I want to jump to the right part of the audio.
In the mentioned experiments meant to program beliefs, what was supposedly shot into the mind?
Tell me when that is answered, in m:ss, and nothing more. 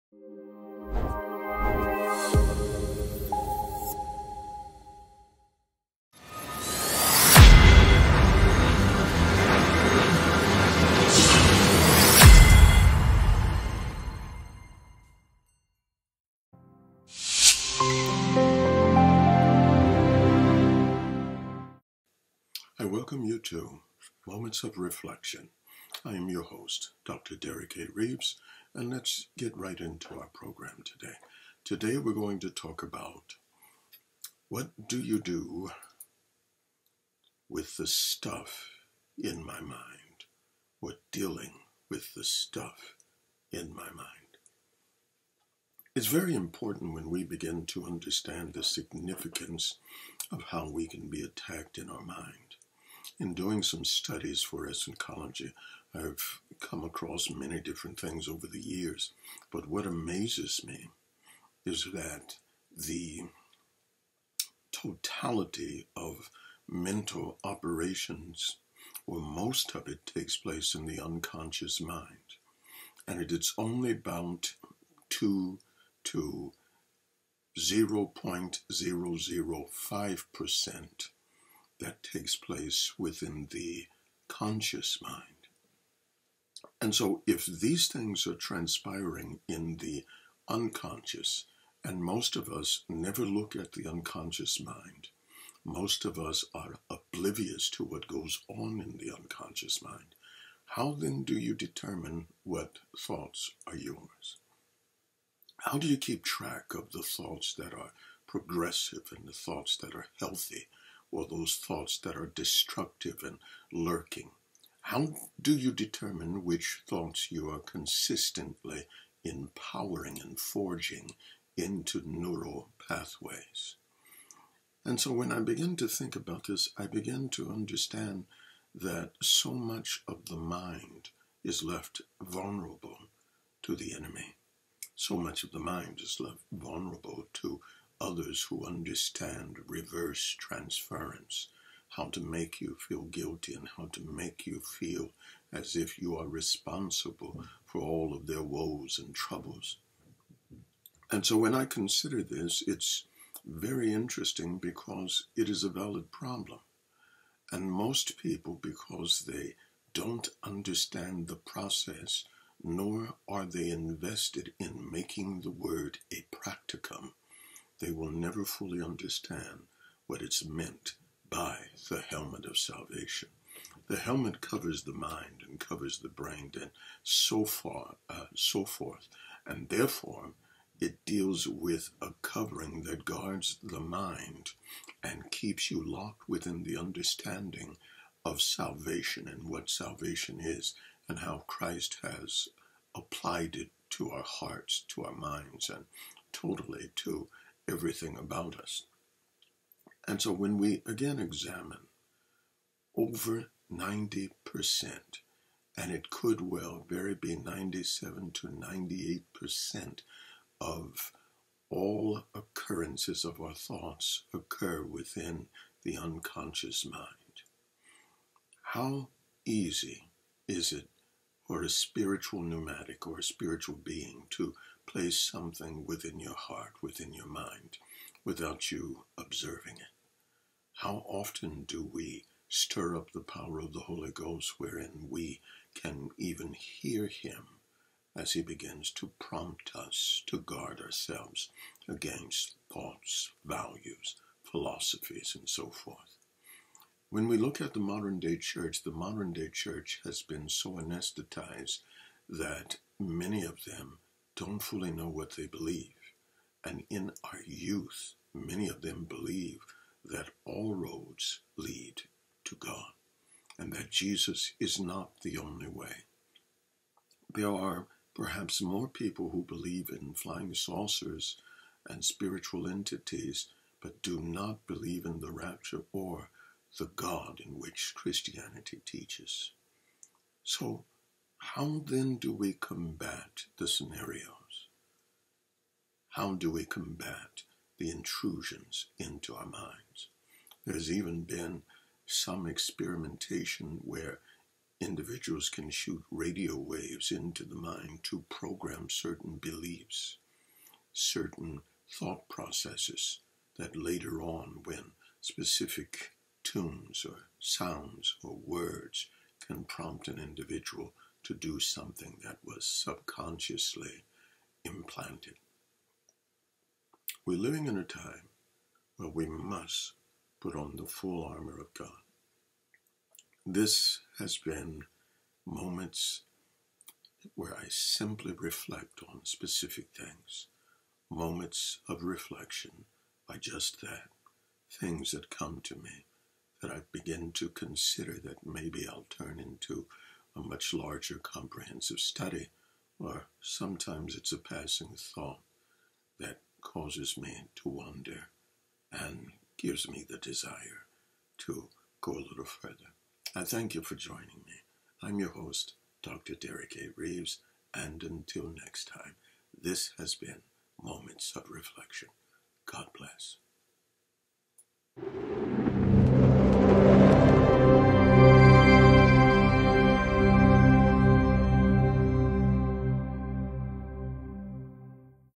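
4:56.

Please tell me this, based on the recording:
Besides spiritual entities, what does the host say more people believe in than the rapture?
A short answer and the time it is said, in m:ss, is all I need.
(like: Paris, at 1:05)
flying saucers, at 4:30.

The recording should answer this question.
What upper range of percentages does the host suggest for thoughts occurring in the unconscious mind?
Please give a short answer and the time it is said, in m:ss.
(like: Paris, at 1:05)
97 to 98%, at 3:27.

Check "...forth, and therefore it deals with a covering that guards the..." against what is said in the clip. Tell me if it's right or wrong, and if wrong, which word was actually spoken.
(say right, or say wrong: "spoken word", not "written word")
right.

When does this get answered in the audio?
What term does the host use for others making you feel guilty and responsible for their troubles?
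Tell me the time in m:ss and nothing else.
2:19.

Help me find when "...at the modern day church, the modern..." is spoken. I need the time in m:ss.
4:07.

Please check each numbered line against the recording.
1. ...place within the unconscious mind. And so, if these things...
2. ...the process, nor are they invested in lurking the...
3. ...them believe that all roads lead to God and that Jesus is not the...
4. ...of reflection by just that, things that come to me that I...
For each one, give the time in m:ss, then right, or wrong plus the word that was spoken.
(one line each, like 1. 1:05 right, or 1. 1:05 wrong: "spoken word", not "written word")
1. 1:22 wrong: "conscious", not "unconscious"
2. 2:41 wrong: "making", not "lurking"
3. 4:18 right
4. 5:31 right.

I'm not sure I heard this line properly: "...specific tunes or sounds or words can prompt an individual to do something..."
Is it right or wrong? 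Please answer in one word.
right.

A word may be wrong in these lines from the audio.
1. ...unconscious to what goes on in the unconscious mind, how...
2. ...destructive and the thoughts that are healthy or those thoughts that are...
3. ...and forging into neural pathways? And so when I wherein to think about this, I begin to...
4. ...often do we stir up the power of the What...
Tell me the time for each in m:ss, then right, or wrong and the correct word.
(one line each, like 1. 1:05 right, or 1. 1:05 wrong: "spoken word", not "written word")
1. 1:36 wrong: "oblivious", not "unconscious"
2. 1:48 wrong: "progressive", not "destructive"
3. 2:00 wrong: "begin", not "wherein"
4. 3:51 wrong: "Holy", not "What".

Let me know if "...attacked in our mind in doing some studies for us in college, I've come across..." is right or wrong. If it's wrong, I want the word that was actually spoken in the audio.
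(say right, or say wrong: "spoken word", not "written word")
right.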